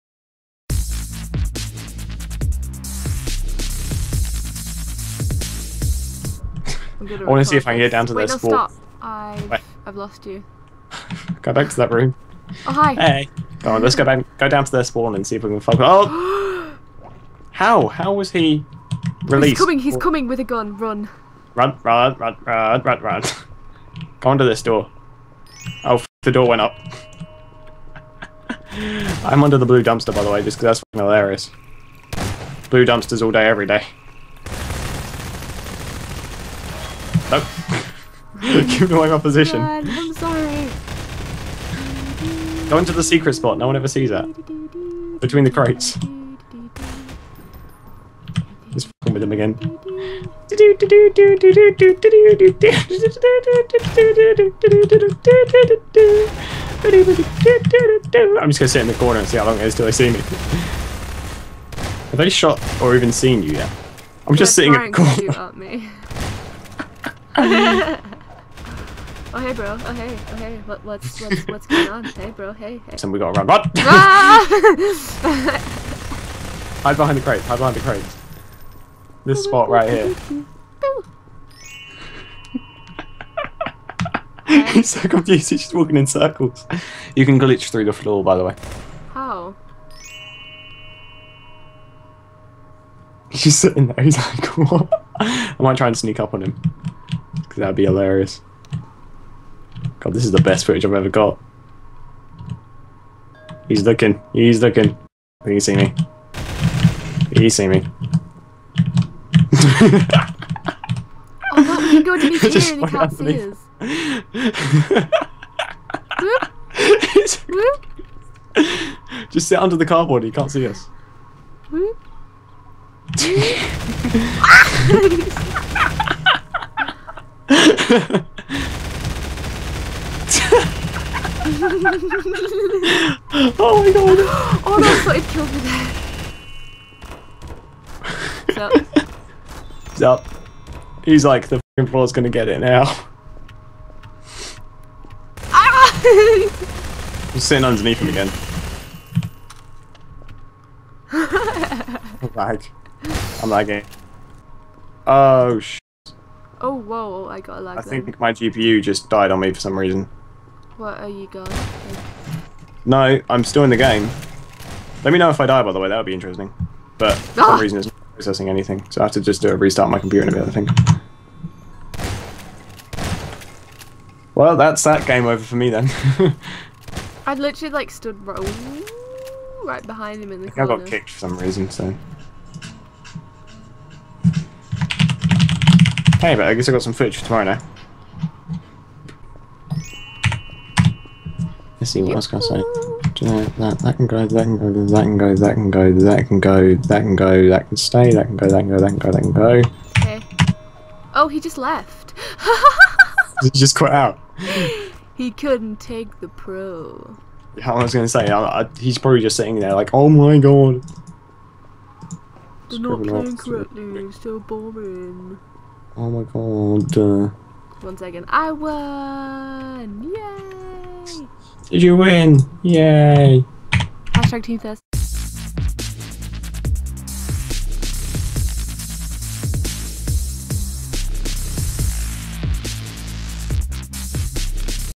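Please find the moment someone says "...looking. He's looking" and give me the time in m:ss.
1:43.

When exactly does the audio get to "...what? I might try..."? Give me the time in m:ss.
1:34.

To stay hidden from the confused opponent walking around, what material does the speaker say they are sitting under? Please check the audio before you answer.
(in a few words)
Cardboard.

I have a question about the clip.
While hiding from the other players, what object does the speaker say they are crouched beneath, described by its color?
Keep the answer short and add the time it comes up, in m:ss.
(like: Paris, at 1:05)
Blue dumpster, at 0:29.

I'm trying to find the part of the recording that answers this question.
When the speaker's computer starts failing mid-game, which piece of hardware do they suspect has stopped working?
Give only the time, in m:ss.
2:38.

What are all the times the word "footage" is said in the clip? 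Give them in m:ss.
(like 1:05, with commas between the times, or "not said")
1:40, 3:06.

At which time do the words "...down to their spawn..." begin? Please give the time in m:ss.
0:14.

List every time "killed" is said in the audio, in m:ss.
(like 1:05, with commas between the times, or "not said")
2:15.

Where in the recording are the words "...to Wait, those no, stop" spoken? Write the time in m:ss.
0:08.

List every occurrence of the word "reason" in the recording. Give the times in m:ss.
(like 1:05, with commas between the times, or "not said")
2:39, 2:47, 3:01.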